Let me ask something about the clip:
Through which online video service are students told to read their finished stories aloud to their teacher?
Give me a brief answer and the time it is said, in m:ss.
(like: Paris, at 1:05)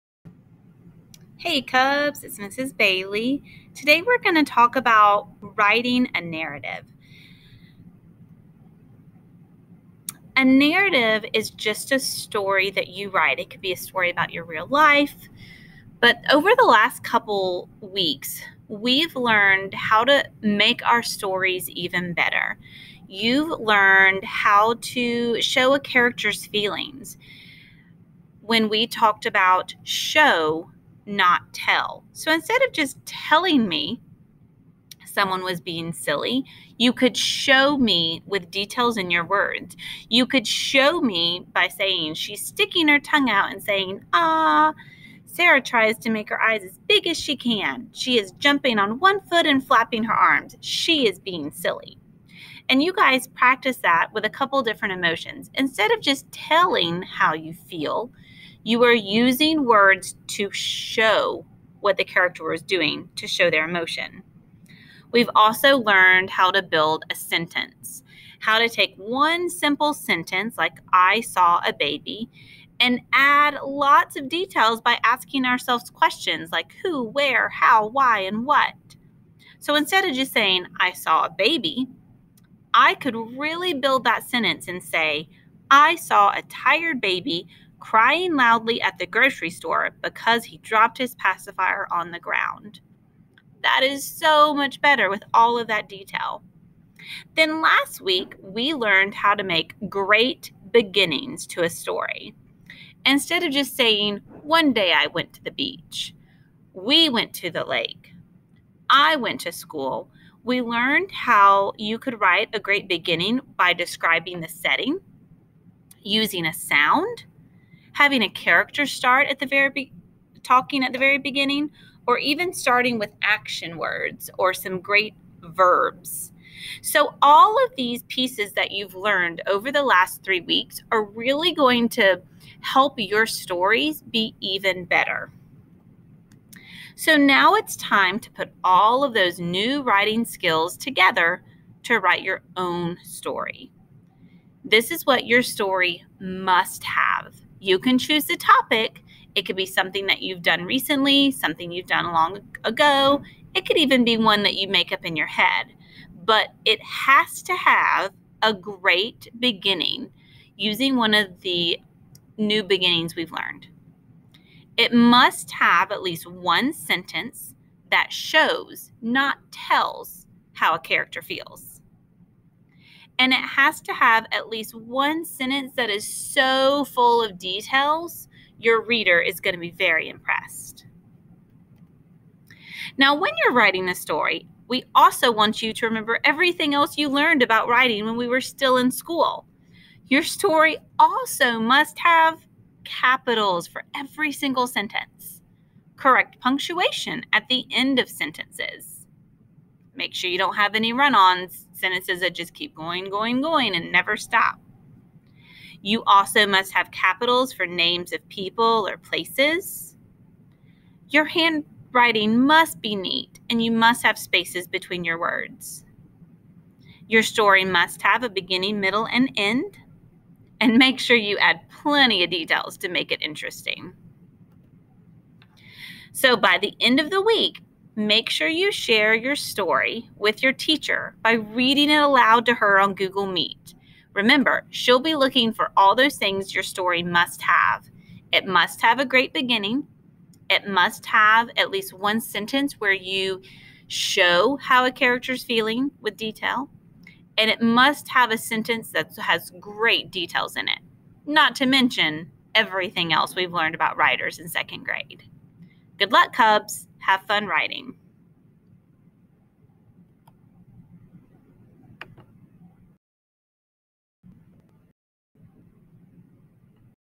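Google Meet, at 3:52.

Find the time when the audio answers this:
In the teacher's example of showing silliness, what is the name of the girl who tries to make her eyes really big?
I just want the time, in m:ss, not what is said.
0:45.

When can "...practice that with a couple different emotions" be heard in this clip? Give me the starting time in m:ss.
0:53.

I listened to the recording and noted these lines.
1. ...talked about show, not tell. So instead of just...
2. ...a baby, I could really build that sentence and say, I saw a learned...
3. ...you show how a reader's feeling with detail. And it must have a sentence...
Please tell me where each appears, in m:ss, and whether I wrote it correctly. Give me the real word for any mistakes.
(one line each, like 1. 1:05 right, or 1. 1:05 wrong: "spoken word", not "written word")
1. 0:28 right
2. 1:21 wrong: "tired", not "learned"
3. 4:02 wrong: "character", not "reader".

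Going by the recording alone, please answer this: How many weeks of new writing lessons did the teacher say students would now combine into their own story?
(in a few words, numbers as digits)
3.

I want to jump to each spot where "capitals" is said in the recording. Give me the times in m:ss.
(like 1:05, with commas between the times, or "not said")
3:12, 3:26.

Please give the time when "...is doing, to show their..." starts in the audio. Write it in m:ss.
1:02.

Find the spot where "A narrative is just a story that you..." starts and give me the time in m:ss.
0:10.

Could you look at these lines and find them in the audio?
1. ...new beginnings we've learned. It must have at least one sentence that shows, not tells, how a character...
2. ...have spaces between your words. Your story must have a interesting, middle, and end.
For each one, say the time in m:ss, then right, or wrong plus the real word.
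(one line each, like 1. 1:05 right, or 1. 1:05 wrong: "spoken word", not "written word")
1. 2:42 right
2. 3:34 wrong: "beginning", not "interesting".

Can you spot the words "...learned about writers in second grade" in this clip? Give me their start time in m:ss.
4:13.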